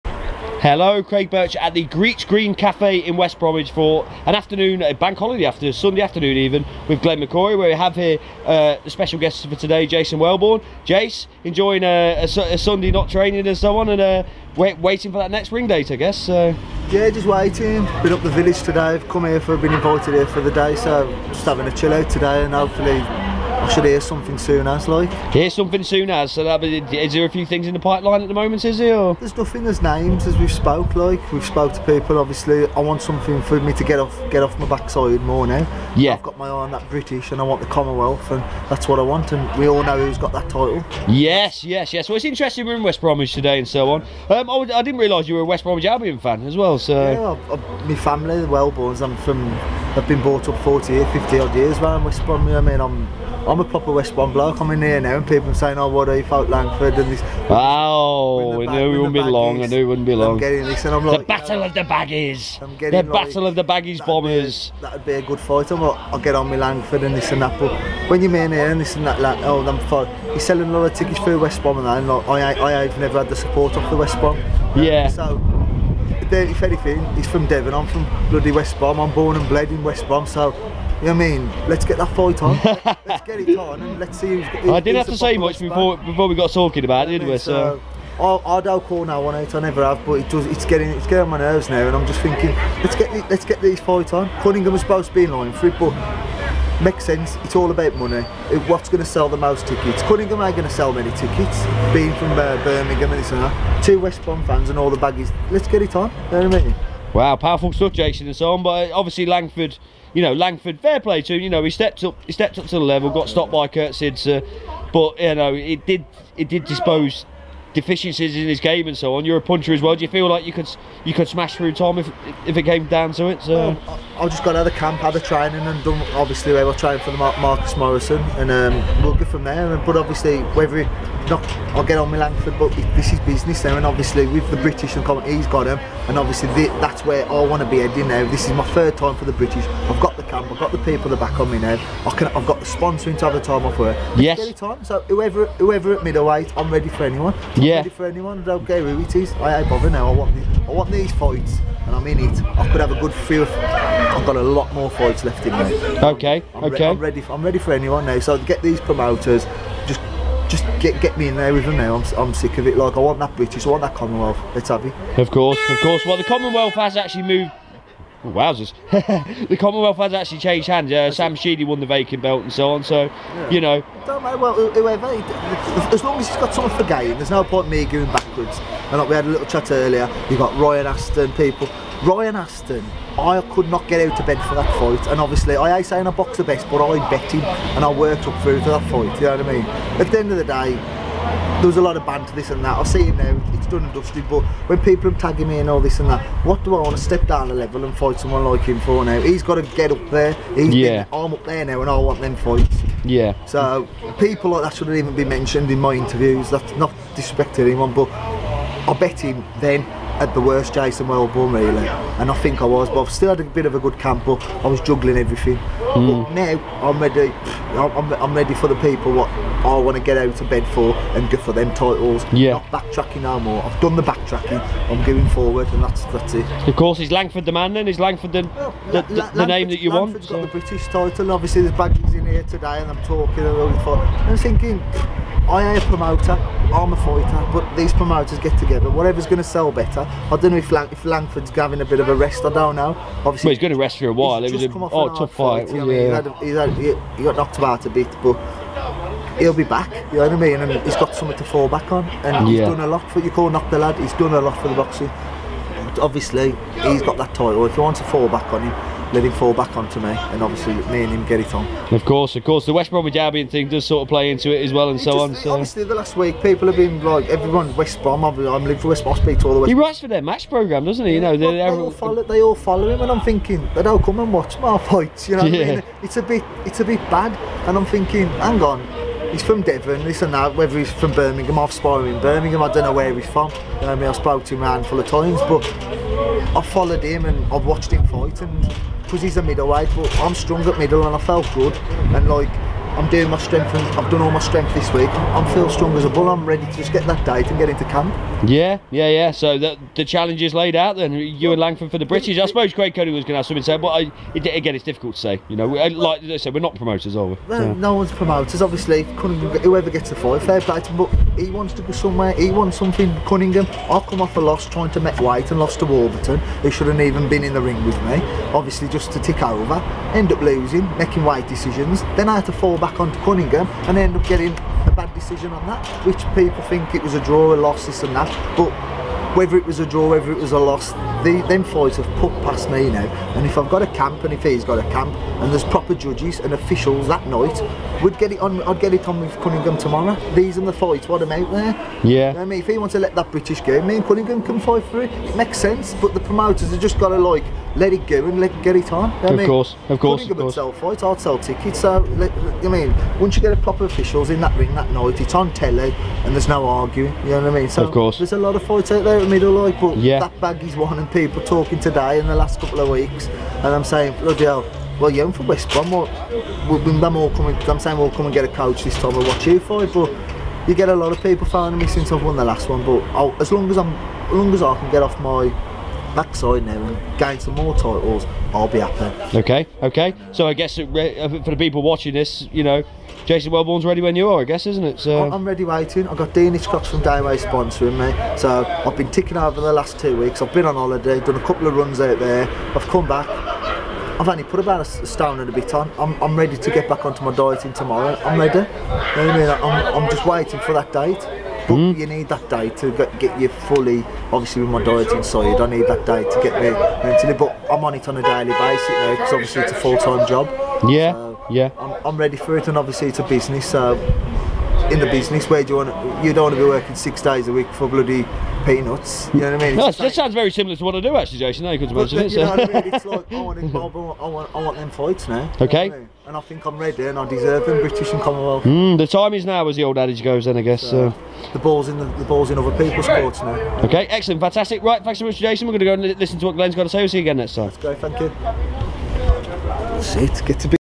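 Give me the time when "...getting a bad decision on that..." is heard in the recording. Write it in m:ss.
5:24.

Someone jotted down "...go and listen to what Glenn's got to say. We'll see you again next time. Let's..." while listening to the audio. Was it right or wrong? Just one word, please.
right.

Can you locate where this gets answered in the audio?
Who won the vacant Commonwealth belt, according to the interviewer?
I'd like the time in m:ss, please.
2:51.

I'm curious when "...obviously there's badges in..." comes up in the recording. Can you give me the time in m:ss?
3:51.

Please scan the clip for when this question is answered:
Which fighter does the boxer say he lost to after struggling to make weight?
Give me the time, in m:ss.
5:15.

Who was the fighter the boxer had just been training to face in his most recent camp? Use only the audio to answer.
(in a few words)
Marcus Morrison.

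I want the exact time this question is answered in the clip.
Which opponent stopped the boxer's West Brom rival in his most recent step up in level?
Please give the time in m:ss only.
1:53.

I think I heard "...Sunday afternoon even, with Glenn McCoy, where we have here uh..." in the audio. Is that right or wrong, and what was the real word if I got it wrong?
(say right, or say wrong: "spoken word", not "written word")
right.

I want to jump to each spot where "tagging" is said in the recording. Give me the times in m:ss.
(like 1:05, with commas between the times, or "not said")
3:15.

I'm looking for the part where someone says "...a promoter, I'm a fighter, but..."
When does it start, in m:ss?
3:55.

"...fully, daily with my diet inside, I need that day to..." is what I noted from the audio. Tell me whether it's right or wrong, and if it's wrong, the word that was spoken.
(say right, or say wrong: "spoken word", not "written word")
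wrong: "obviously", not "daily".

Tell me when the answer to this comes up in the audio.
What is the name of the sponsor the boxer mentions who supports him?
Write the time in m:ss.
6:26.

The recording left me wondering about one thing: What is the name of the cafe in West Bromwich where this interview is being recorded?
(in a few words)
Greets Green Cafe.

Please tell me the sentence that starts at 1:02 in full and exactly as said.
I'm getting the like, battle of the baggies that'd bombers.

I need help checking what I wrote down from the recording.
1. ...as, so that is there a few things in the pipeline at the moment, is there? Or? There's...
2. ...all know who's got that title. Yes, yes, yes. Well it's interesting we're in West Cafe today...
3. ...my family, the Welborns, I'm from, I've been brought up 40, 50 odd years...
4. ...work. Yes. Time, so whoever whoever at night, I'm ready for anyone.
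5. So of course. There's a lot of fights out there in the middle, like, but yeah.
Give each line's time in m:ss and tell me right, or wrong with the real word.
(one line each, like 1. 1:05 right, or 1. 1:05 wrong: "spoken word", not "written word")
1. 0:26 right
2. 0:39 wrong: "Bromwich", not "Cafe"
3. 0:47 right
4. 2:23 wrong: "middleweight", not "night"
5. 5:57 right.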